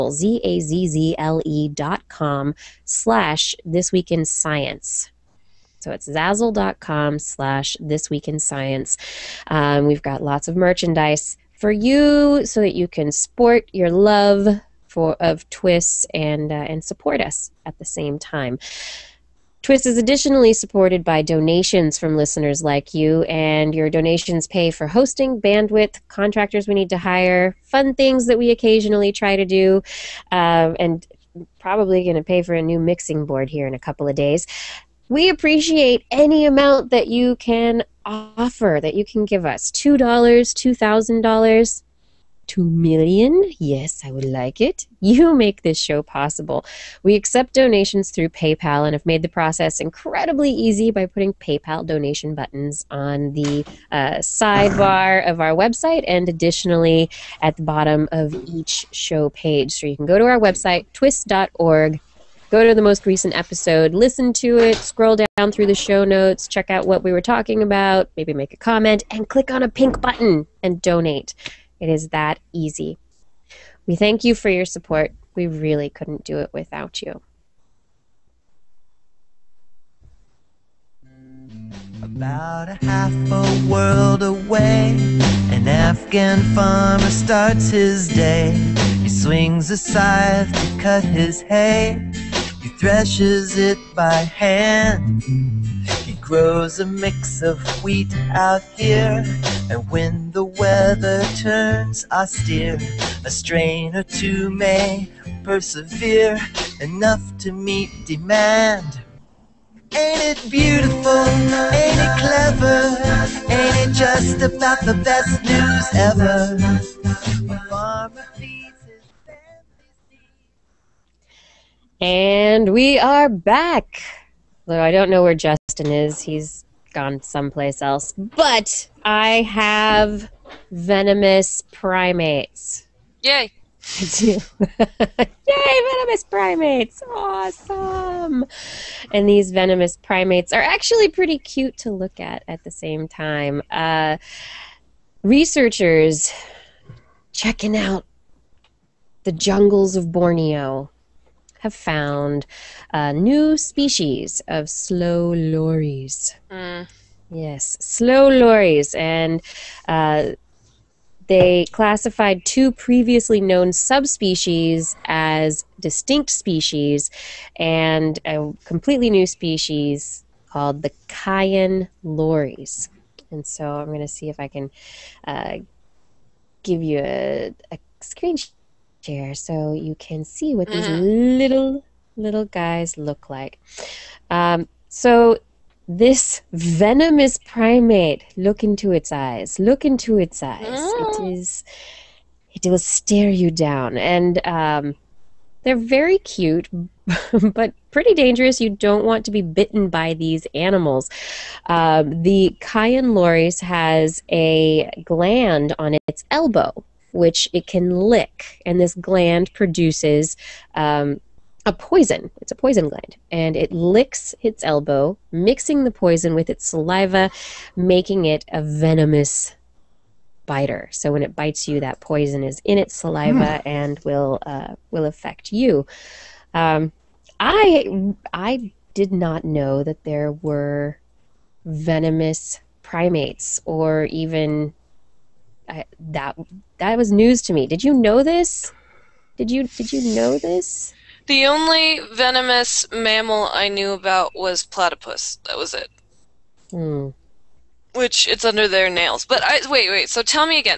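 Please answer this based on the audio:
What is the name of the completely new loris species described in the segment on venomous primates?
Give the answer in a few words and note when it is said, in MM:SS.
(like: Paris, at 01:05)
Kayan loris, at 02:51.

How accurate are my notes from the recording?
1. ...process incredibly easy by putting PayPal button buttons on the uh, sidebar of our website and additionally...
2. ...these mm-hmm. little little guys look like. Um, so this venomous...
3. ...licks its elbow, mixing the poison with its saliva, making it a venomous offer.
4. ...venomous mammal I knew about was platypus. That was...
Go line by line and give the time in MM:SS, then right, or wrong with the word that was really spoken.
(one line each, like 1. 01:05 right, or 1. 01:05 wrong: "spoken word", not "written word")
1. 00:49 wrong: "donation", not "button"
2. 03:00 right
3. 03:33 wrong: "biter", not "offer"
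4. 04:02 right.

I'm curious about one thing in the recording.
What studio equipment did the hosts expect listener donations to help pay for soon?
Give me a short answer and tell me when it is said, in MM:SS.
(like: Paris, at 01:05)
mixing board, at 00:32.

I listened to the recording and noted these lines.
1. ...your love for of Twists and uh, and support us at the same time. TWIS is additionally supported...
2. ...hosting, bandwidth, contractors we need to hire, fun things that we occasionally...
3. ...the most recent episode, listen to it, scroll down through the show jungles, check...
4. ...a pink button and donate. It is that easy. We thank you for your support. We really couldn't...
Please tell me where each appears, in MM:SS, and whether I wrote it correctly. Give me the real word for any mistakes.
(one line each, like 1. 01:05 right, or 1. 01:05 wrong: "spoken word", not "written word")
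1. 00:13 right
2. 00:24 right
3. 01:02 wrong: "notes", not "jungles"
4. 01:09 right.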